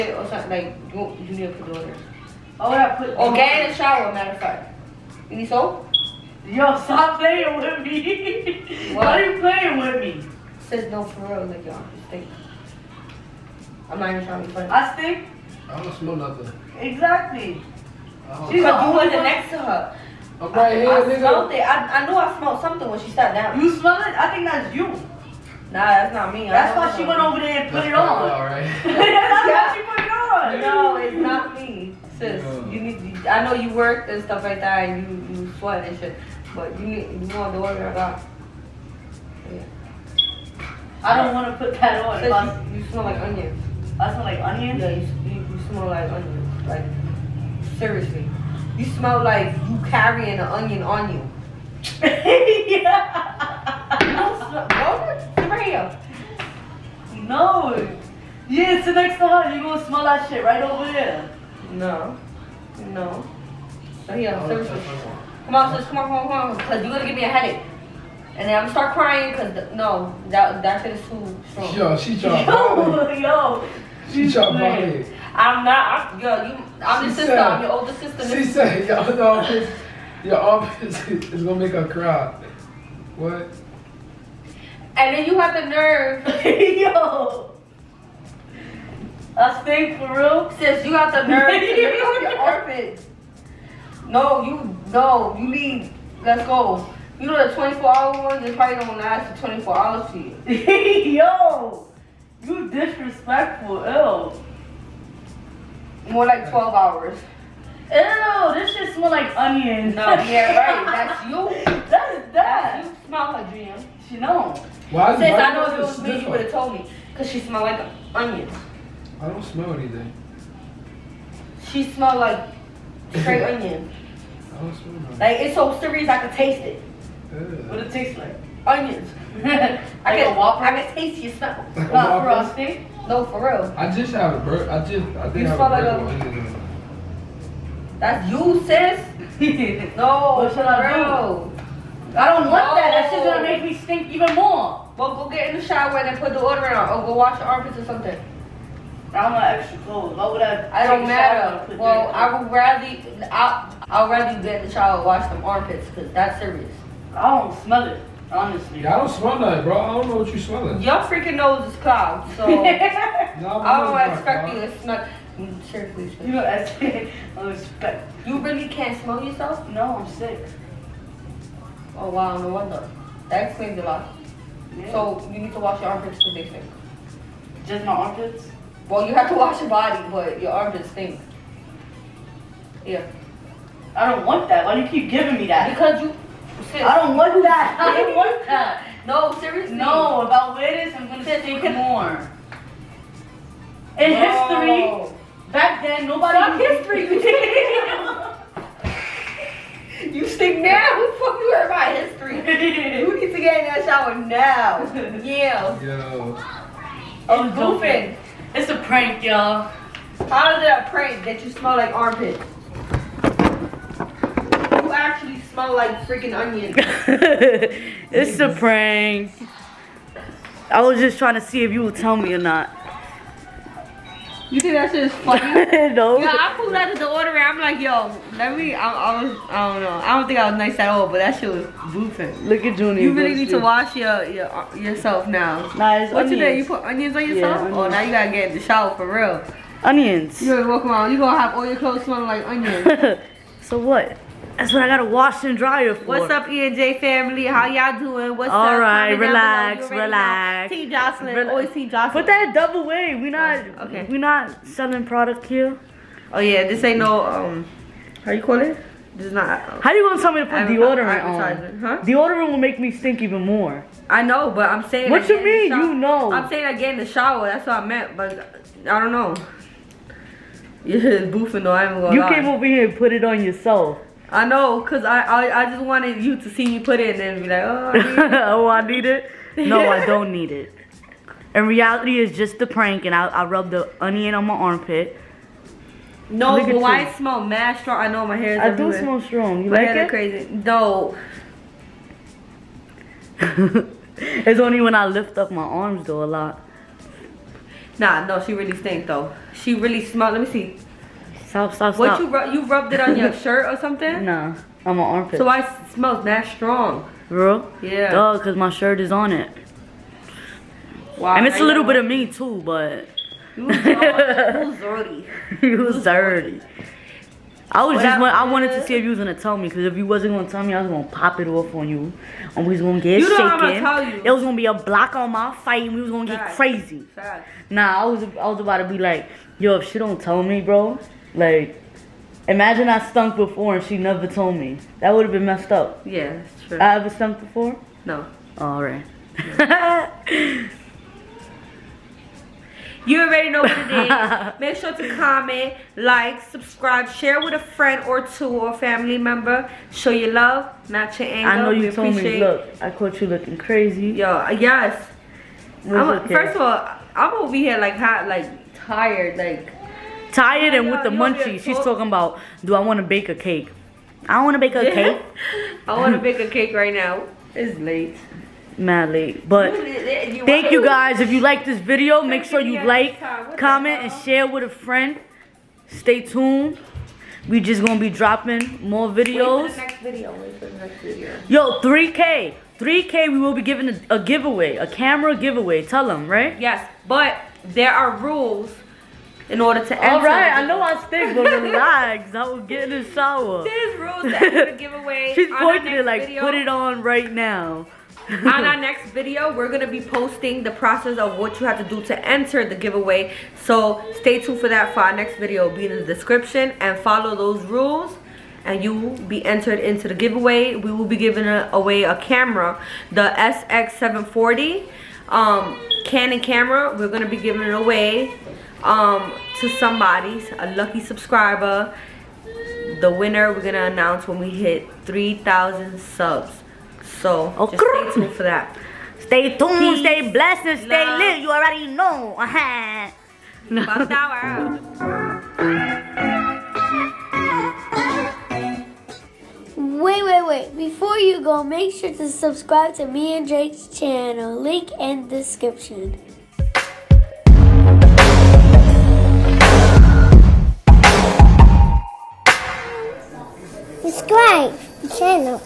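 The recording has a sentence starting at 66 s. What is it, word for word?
Because you're going to give me a headache.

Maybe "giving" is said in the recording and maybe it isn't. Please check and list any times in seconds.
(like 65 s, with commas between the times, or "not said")
185 s, 383 s, 411 s, 417 s.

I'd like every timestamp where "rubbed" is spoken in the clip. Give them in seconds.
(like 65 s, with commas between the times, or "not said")
283 s, 302 s.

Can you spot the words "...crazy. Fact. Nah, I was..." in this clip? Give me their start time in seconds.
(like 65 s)
326 s.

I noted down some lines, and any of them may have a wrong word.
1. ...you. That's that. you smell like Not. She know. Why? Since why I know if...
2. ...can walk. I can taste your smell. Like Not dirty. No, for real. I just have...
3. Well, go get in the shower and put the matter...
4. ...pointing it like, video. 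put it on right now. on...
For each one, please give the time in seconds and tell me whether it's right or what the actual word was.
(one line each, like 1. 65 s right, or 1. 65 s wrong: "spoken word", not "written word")
1. 111 s wrong: "Dream", not "Not"
2. 130 s wrong: "frosty", not "dirty"
3. 144 s wrong: "order", not "matter"
4. 395 s right.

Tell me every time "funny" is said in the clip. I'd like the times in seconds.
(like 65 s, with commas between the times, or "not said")
14 s, 225 s.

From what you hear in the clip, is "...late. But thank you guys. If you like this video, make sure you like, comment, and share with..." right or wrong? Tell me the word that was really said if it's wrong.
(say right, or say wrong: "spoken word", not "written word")
right.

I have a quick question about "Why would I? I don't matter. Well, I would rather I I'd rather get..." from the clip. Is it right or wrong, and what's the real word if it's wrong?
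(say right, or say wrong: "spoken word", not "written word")
right.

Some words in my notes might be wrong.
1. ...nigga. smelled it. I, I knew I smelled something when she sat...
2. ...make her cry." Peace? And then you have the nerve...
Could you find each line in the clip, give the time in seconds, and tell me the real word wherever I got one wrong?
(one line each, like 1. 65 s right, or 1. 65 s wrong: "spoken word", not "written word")
1. 21 s right
2. 81 s wrong: "What", not "Peace".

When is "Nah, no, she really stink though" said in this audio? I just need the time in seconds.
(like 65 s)
297 s.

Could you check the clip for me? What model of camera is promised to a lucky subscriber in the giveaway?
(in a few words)
SX740.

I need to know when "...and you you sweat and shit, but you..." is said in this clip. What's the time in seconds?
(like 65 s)
34 s.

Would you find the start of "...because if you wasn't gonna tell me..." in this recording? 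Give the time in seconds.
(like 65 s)
319 s.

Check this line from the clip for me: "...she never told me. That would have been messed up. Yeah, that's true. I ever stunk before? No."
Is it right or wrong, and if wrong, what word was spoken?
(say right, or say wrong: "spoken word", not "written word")
right.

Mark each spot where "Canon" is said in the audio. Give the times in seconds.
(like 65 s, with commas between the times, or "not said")
416 s.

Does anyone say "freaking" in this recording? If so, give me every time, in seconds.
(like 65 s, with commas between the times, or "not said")
161 s, 216 s.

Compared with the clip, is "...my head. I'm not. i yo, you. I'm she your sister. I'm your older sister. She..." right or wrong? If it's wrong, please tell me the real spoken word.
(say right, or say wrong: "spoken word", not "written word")
right.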